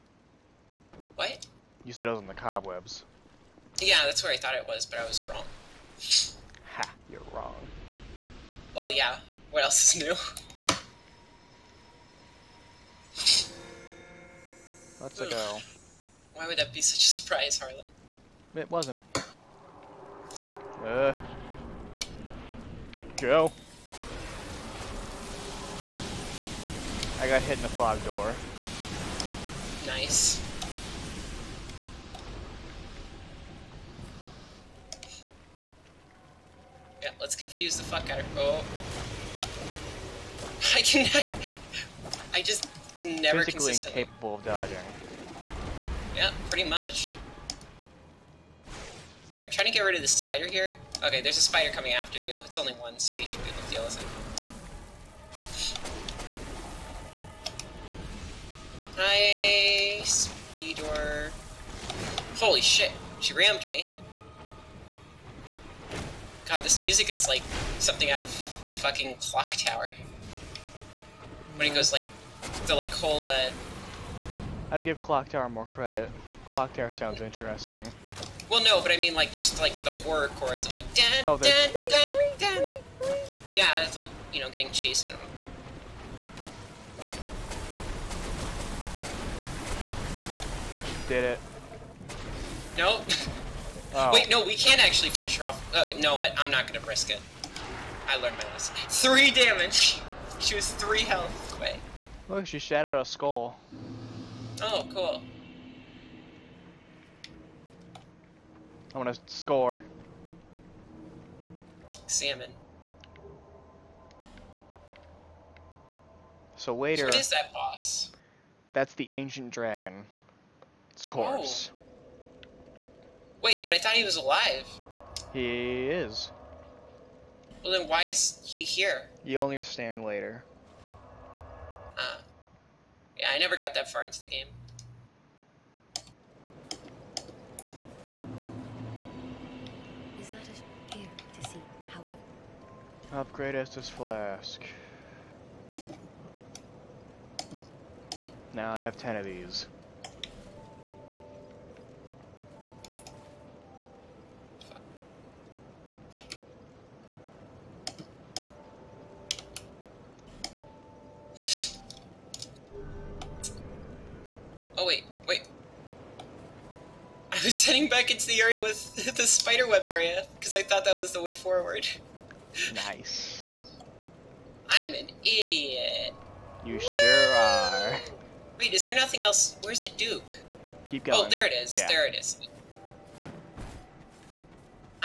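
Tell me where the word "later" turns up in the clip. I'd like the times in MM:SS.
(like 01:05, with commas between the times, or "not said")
01:56, 02:10.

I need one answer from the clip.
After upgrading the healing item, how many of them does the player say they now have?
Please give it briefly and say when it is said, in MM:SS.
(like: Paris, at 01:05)
10, at 02:28.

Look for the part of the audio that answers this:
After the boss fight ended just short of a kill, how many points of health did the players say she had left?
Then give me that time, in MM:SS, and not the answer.
01:38.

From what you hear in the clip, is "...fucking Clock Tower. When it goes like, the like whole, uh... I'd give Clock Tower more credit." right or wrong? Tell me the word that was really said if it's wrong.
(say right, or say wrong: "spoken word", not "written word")
right.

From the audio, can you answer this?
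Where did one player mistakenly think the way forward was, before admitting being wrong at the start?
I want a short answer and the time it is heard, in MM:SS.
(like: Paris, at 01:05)
The cobwebs, at 00:02.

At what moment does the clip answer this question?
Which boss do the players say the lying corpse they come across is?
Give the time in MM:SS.
01:58.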